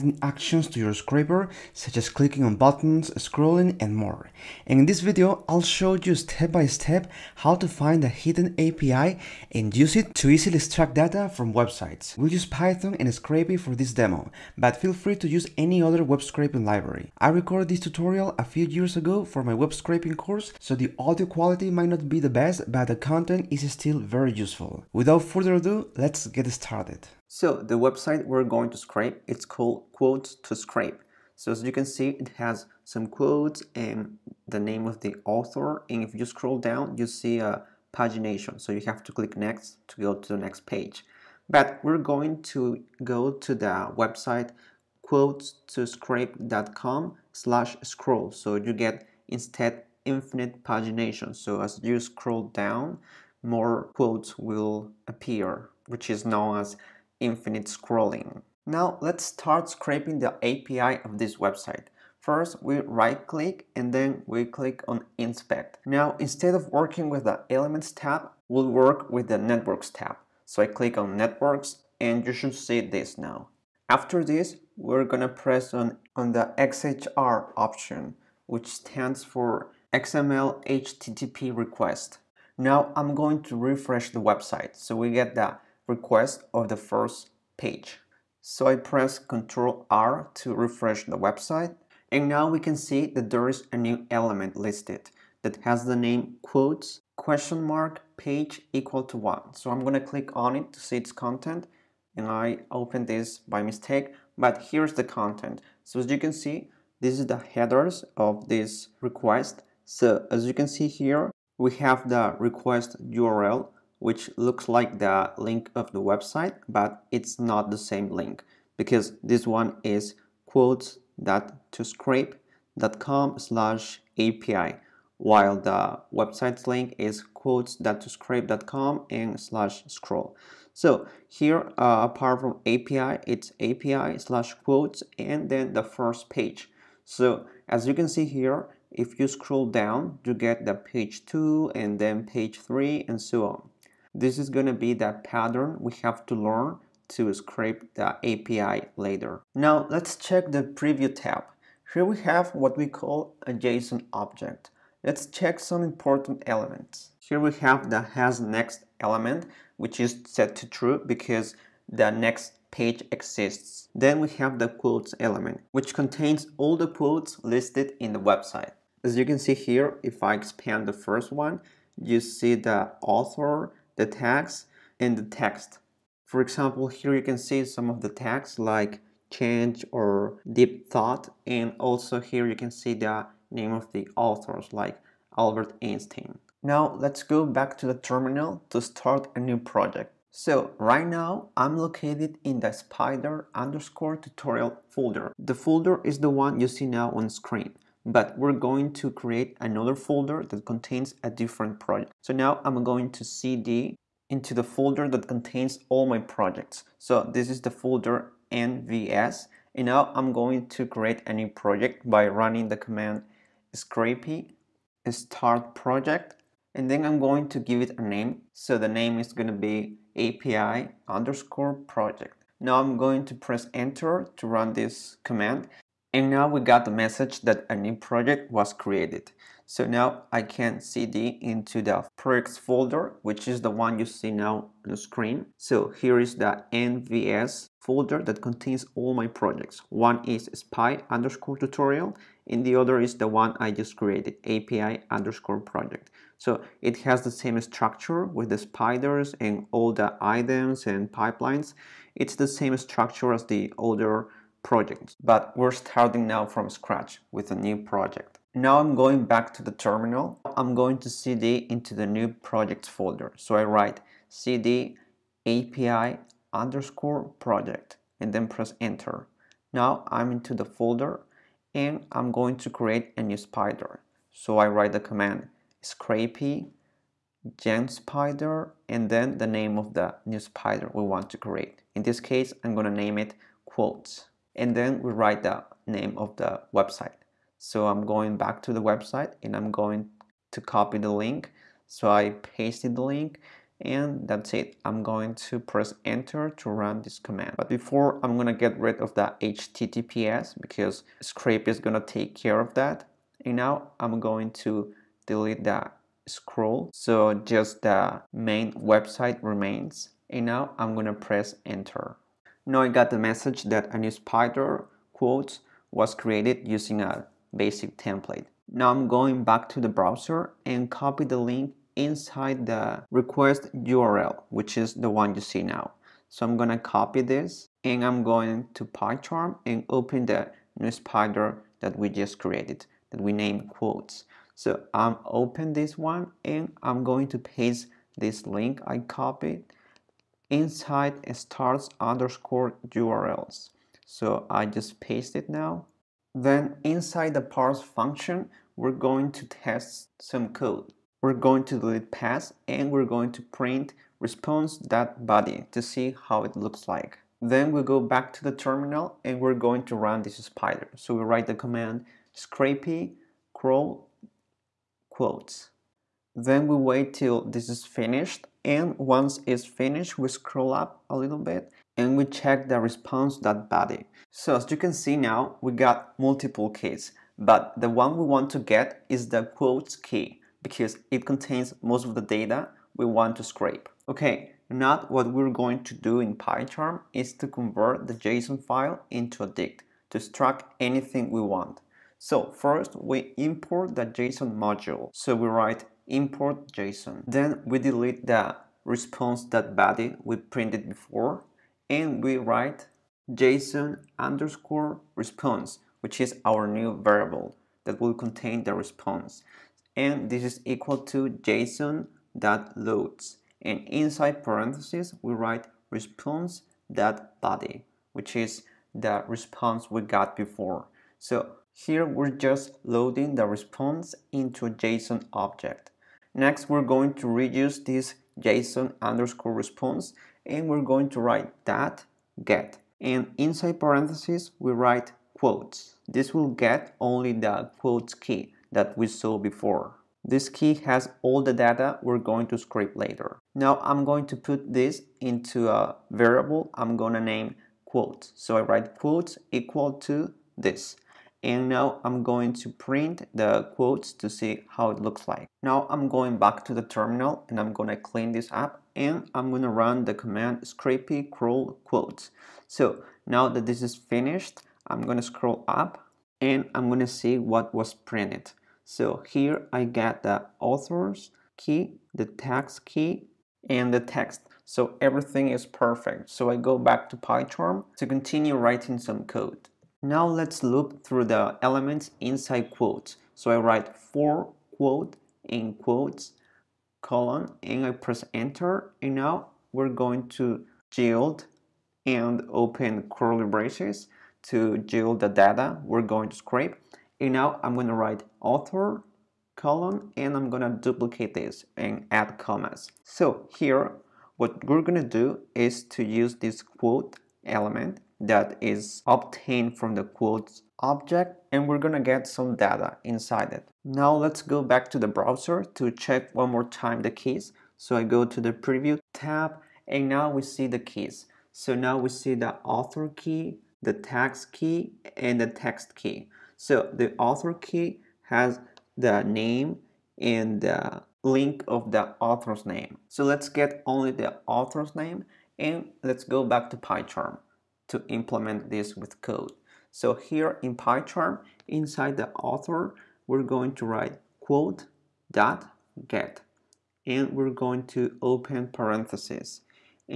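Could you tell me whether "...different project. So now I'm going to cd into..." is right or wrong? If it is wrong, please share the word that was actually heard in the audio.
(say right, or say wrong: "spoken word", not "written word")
right.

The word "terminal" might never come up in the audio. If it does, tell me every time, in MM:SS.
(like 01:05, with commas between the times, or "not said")
03:07, 04:19, 05:58, 07:36.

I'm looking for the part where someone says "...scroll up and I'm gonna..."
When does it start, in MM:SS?
07:45.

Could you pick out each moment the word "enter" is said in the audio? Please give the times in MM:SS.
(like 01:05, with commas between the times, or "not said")
03:43, 04:28, 04:56, 05:11, 08:08.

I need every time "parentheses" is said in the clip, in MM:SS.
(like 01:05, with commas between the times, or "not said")
06:54, 07:13, 09:08.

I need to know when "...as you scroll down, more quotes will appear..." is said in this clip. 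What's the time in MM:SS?
00:51.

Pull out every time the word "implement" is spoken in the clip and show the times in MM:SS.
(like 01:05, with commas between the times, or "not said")
08:58.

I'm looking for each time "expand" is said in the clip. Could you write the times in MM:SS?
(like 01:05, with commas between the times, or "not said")
02:50.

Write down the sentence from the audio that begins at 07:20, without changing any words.
This key has all the data we're going to scrape later.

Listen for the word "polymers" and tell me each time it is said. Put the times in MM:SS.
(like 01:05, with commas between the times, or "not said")
not said.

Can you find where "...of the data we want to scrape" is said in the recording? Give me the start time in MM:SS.
06:22.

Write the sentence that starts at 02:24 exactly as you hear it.
This is going to be that pattern we have to learn to scrape the API later.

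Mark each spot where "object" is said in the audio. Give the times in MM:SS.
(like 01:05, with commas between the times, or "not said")
02:34, 07:05, 08:30.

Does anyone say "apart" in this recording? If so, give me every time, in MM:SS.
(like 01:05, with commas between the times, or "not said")
02:12.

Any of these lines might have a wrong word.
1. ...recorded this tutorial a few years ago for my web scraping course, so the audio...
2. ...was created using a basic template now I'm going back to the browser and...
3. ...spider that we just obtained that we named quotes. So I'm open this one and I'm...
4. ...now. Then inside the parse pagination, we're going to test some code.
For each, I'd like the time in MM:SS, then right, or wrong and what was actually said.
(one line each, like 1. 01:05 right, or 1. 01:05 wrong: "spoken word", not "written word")
1. 00:17 right
2. 05:15 right
3. 05:30 wrong: "created", not "obtained"
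4. 05:45 wrong: "function", not "pagination".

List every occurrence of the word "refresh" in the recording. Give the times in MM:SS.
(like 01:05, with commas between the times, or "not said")
01:23, 01:30.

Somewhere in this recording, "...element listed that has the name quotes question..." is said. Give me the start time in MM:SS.
01:34.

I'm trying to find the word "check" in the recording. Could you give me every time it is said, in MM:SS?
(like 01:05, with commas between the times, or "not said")
02:30, 02:35, 06:12, 08:35.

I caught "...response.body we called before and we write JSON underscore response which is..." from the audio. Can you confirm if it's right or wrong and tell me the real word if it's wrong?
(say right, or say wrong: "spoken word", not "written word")
wrong: "printed", not "called".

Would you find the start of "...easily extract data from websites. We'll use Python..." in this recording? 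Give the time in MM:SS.
00:10.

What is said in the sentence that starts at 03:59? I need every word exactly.
One is spy underscore tutorial and the other is the one I just created, API underscore project.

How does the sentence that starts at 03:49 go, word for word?
So now I can cd into the projects folder, which is the one you see now on the screen.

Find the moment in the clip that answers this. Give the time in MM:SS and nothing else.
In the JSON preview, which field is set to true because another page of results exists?
02:38.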